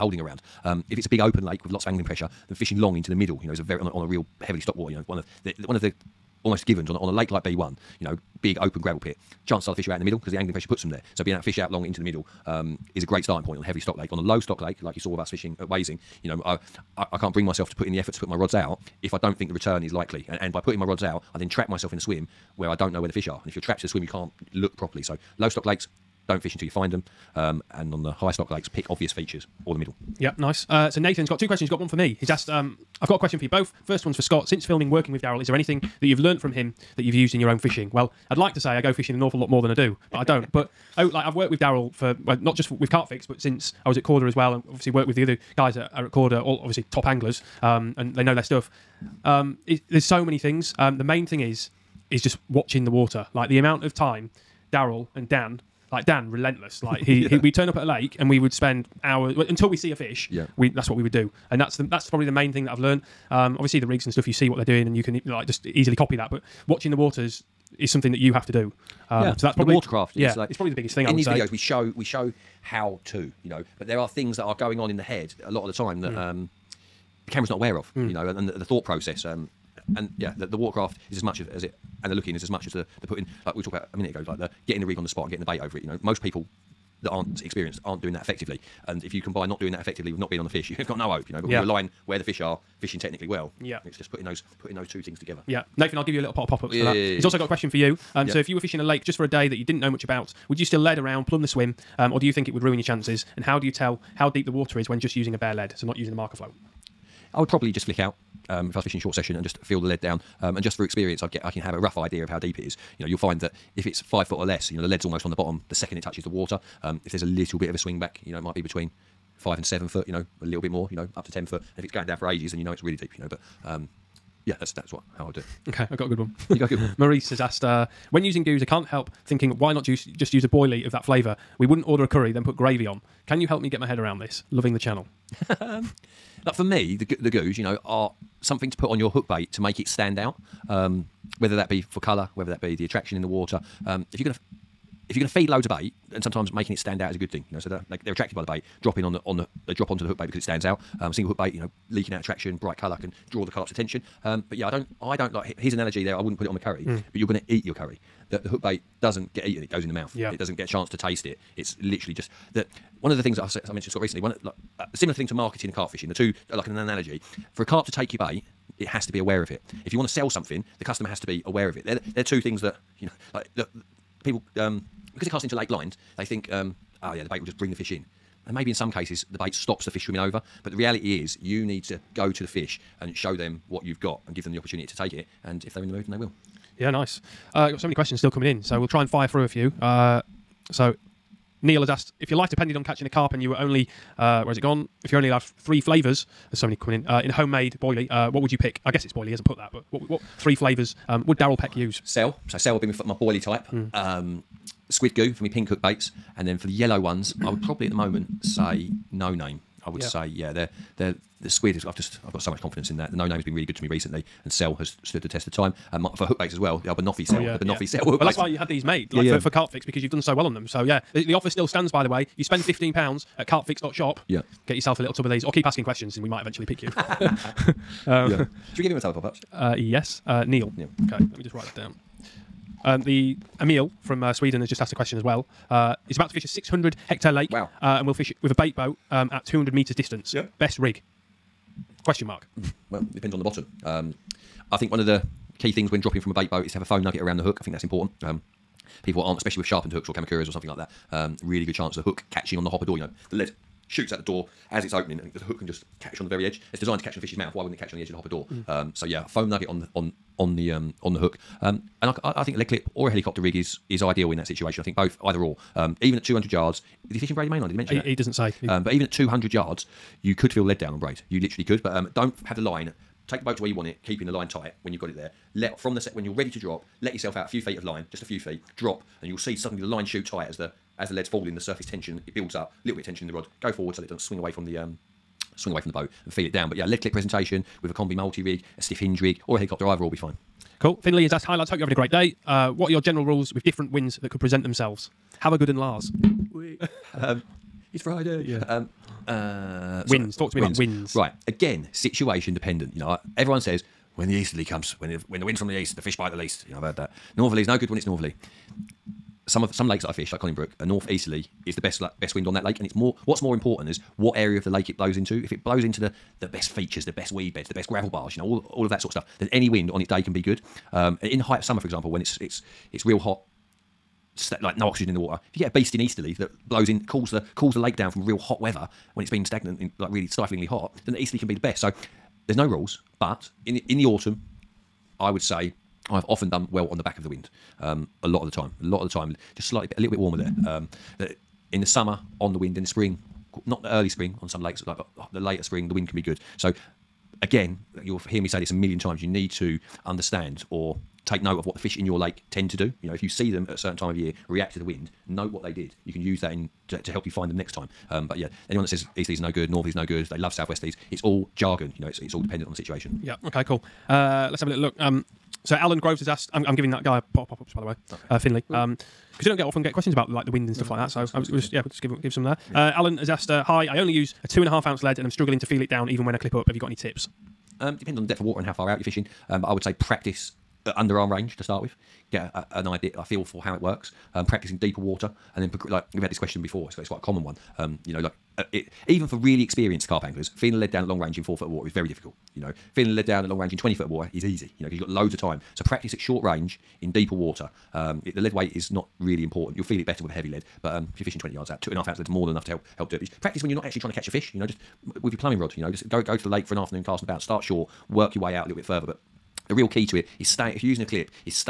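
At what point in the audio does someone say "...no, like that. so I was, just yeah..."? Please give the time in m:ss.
6:10.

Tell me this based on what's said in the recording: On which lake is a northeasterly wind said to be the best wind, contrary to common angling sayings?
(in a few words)
Conningbrook.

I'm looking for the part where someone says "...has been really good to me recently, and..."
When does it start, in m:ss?
3:33.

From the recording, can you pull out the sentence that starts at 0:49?
Um, it, there's so many things.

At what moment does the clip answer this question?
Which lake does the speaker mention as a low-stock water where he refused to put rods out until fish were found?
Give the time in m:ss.
0:15.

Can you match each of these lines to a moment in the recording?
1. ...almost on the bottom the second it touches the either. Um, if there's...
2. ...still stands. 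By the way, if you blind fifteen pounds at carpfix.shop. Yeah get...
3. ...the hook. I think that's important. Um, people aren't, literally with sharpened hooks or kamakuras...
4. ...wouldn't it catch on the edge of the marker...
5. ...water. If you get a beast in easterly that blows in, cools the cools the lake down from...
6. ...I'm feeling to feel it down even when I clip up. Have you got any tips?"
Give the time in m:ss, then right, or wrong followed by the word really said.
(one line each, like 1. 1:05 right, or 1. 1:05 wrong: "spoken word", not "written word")
1. 1:55 wrong: "water", not "either"
2. 3:41 wrong: "spend", not "blind"
3. 4:07 wrong: "especially", not "literally"
4. 4:17 wrong: "hopper", not "marker"
5. 5:25 right
6. 6:15 wrong: "struggling", not "feeling".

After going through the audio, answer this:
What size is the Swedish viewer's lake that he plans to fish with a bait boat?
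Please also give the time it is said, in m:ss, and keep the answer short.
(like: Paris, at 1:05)
600 hectares, at 3:56.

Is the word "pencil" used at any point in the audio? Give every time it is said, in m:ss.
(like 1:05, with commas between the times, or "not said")
not said.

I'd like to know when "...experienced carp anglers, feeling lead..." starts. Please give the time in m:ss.
6:29.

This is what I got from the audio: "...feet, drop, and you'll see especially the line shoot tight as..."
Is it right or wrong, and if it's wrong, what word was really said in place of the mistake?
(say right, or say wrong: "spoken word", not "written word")
wrong: "suddenly", not "especially".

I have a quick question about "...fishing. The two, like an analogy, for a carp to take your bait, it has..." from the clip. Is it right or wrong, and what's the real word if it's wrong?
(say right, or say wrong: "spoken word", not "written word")
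right.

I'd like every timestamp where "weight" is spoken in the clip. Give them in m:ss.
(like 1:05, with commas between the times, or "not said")
6:38.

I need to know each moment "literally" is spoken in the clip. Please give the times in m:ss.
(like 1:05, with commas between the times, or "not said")
2:41, 4:31.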